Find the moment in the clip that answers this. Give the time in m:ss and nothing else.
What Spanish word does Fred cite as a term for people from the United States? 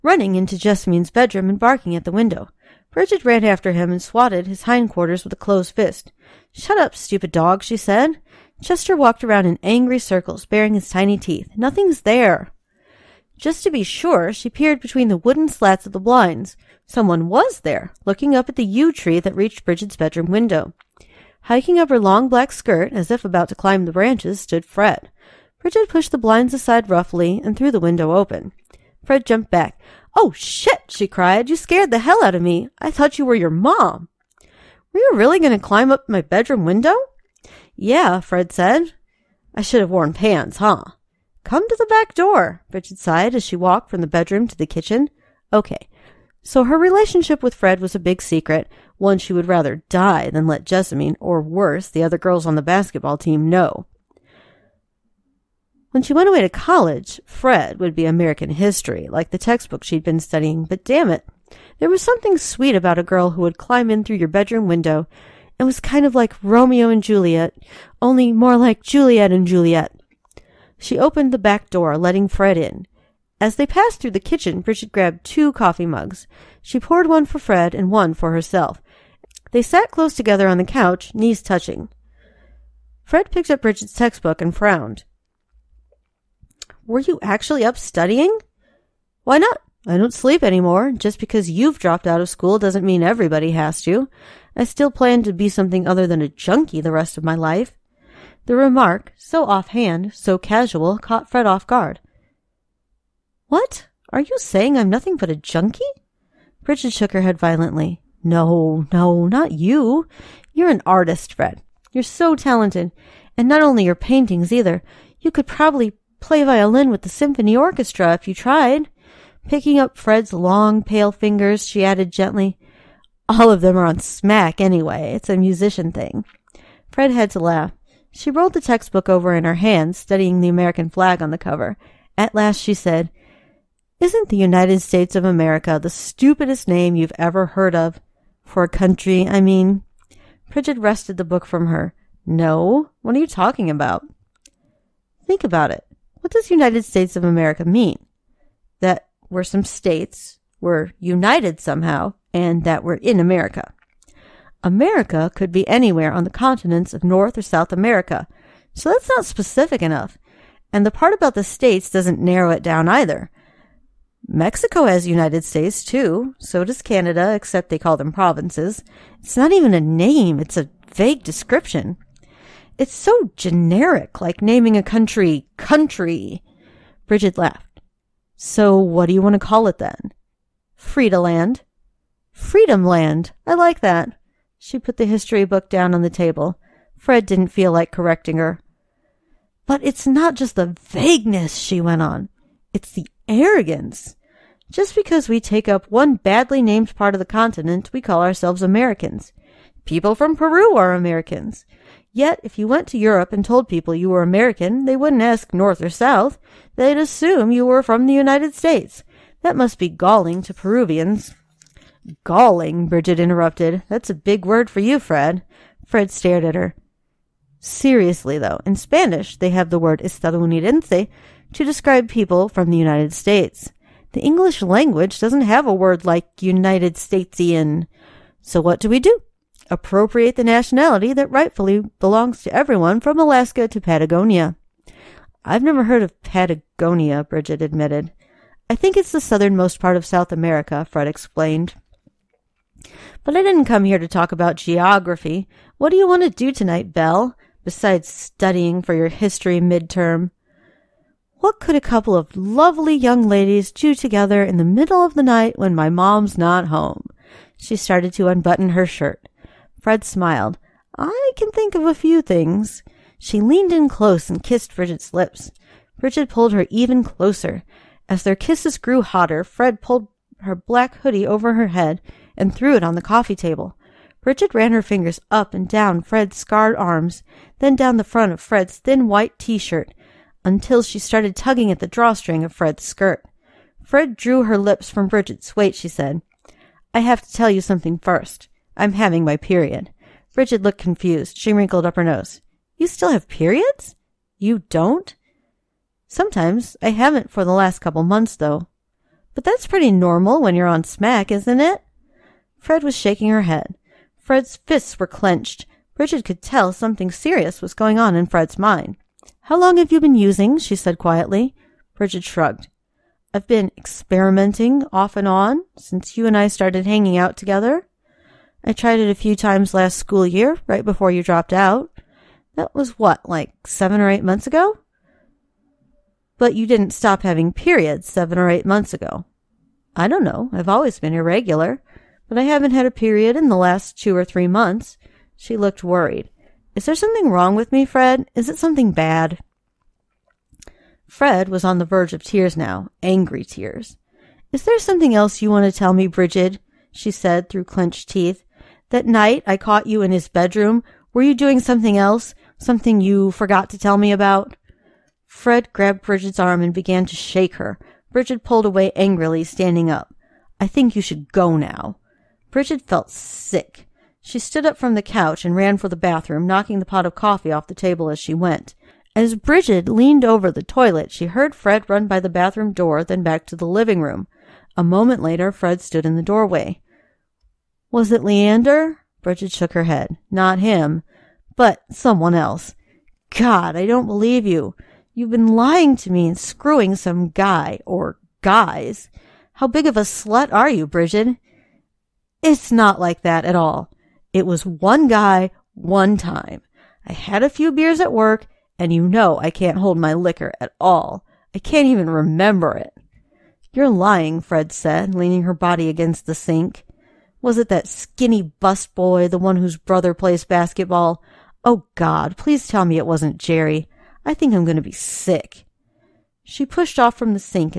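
3:40.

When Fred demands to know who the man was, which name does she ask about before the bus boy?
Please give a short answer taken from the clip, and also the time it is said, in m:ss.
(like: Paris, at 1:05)
Leander, at 6:18.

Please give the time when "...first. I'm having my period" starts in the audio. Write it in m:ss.
4:47.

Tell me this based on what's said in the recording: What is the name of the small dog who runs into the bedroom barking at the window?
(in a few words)
Chester.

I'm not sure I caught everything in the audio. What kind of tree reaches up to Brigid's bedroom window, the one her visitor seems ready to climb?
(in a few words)
yew tree.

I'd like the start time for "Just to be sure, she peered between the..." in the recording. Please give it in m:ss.
0:13.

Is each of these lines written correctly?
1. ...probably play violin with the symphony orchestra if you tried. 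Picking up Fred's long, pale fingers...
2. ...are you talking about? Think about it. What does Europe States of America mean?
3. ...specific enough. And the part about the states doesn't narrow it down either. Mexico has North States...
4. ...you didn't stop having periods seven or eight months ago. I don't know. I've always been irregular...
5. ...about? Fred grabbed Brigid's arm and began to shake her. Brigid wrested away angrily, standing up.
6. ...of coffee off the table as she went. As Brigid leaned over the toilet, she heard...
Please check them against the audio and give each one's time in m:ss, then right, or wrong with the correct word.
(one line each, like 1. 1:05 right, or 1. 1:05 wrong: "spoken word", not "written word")
1. 1:55 right
2. 2:23 wrong: "United", not "Europe"
3. 2:39 wrong: "United", not "North"
4. 5:26 right
5. 5:54 wrong: "pulled", not "wrested"
6. 6:07 right.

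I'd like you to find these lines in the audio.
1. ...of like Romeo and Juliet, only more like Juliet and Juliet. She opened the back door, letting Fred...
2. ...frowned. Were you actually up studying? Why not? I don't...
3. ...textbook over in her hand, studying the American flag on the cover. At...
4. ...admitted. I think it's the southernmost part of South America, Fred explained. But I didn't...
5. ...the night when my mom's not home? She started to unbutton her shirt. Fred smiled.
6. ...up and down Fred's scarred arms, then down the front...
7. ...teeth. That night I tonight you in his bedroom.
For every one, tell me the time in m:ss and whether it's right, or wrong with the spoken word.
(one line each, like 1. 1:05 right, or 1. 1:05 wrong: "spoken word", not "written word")
1. 1:06 right
2. 1:24 right
3. 2:08 right
4. 3:57 right
5. 4:15 right
6. 4:35 right
7. 5:48 wrong: "caught", not "tonight".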